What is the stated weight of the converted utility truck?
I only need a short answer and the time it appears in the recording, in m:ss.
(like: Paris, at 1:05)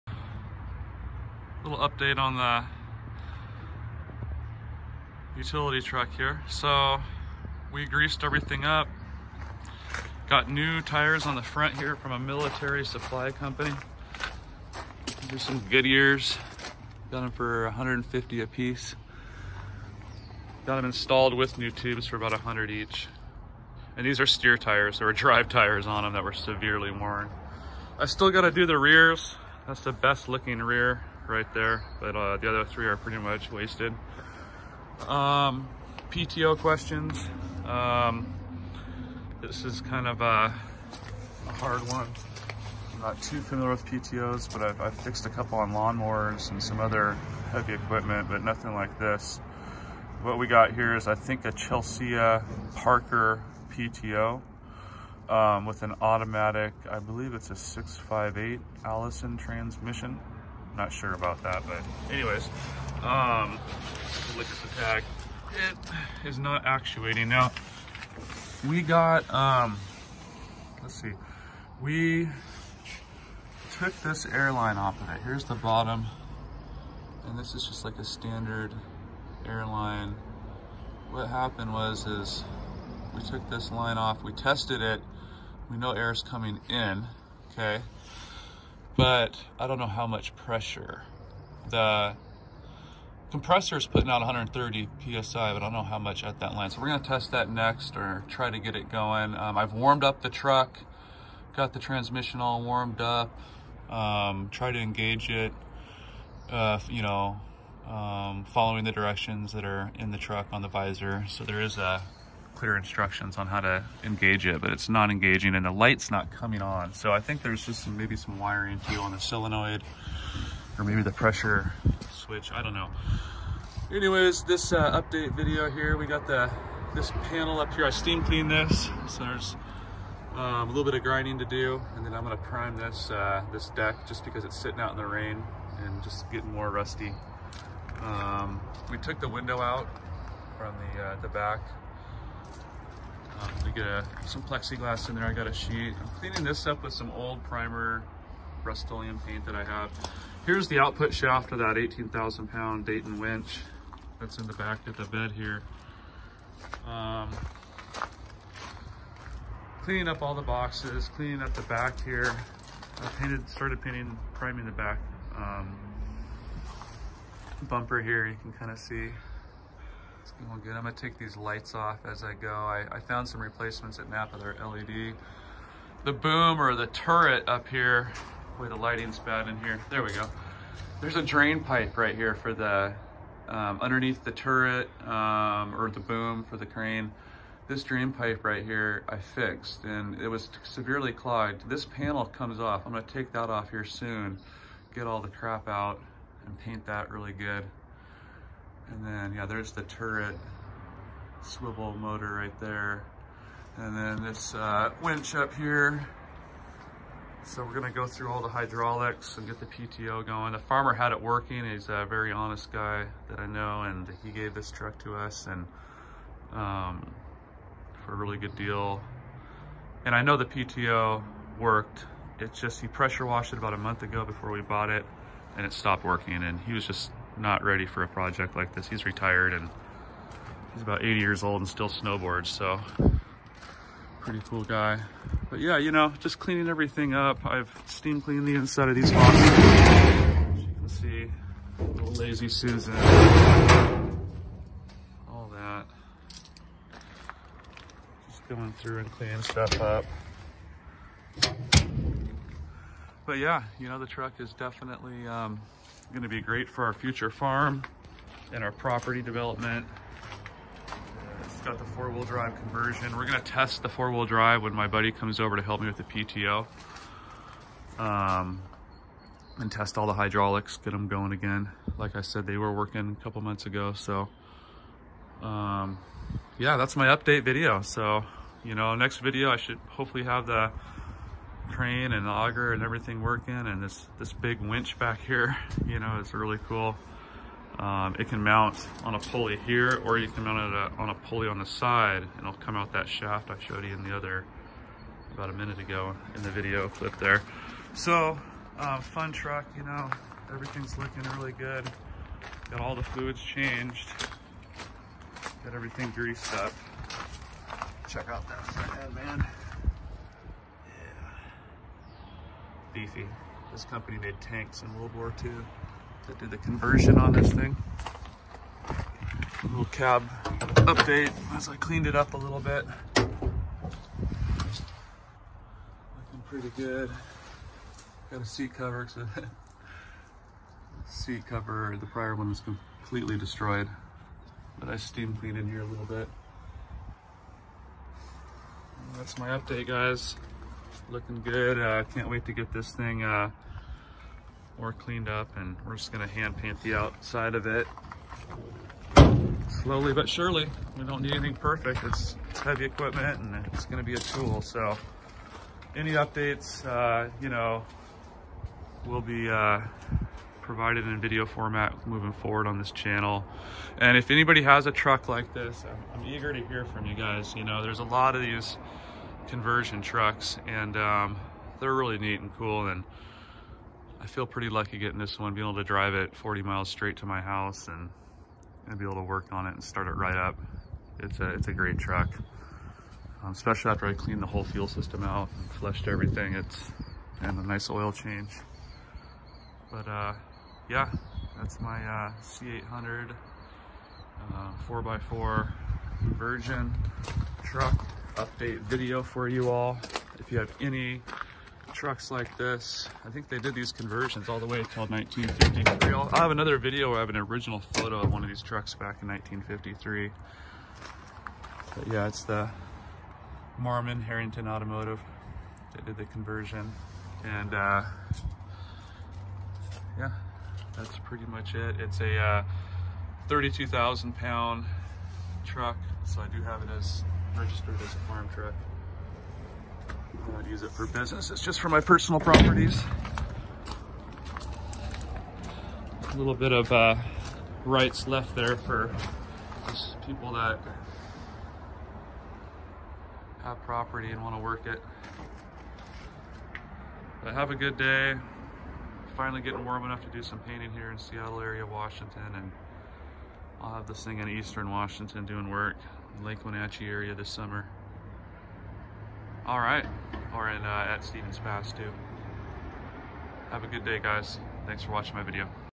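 32,000 pounds, at 7:03.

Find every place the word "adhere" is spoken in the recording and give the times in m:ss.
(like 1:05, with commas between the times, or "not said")
not said.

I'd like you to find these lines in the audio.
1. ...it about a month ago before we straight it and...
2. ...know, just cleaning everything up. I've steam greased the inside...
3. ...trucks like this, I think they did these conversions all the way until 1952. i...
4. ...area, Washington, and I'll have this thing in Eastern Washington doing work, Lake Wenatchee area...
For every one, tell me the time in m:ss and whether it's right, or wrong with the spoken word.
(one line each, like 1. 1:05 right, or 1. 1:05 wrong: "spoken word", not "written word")
1. 3:43 wrong: "bought", not "straight"
2. 3:55 wrong: "cleaned", not "greased"
3. 6:41 wrong: "1953", not "1952"
4. 7:31 right.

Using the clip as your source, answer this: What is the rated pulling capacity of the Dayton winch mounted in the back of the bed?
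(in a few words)
18,000 pounds.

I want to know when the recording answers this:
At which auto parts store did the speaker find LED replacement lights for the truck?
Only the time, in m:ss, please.
2:54.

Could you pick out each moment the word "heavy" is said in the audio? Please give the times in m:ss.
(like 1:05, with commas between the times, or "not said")
0:47, 5:52.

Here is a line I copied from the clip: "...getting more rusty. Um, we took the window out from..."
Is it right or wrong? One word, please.
right.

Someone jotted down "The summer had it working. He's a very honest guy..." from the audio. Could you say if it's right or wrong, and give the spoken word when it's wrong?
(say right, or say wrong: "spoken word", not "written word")
wrong: "farmer", not "summer".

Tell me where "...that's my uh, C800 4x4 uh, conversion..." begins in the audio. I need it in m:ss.
6:31.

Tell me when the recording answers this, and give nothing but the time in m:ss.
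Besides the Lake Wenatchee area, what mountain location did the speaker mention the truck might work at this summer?
7:41.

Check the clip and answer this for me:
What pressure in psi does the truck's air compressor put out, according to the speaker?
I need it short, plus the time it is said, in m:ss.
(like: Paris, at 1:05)
130 psi, at 1:34.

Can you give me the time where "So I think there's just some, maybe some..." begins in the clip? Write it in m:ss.
1:56.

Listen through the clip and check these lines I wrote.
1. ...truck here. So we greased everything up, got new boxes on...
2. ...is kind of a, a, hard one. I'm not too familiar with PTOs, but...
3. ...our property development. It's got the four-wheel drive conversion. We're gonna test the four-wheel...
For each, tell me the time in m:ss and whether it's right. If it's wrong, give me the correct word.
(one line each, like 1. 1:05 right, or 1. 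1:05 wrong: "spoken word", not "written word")
1. 0:05 wrong: "tires", not "boxes"
2. 0:39 right
3. 4:18 right.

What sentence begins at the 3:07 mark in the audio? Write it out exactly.
This drain pipe right here, I fixed and it was severely clogged.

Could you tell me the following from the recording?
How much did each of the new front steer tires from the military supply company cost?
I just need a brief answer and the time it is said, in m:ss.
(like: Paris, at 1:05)
$150, at 0:17.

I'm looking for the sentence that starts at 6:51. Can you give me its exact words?
But yeah, it's the Marmon Herrington Automotive that did the conversion.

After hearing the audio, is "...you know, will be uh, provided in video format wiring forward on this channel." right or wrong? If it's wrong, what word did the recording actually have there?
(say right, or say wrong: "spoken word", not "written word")
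wrong: "moving", not "wiring".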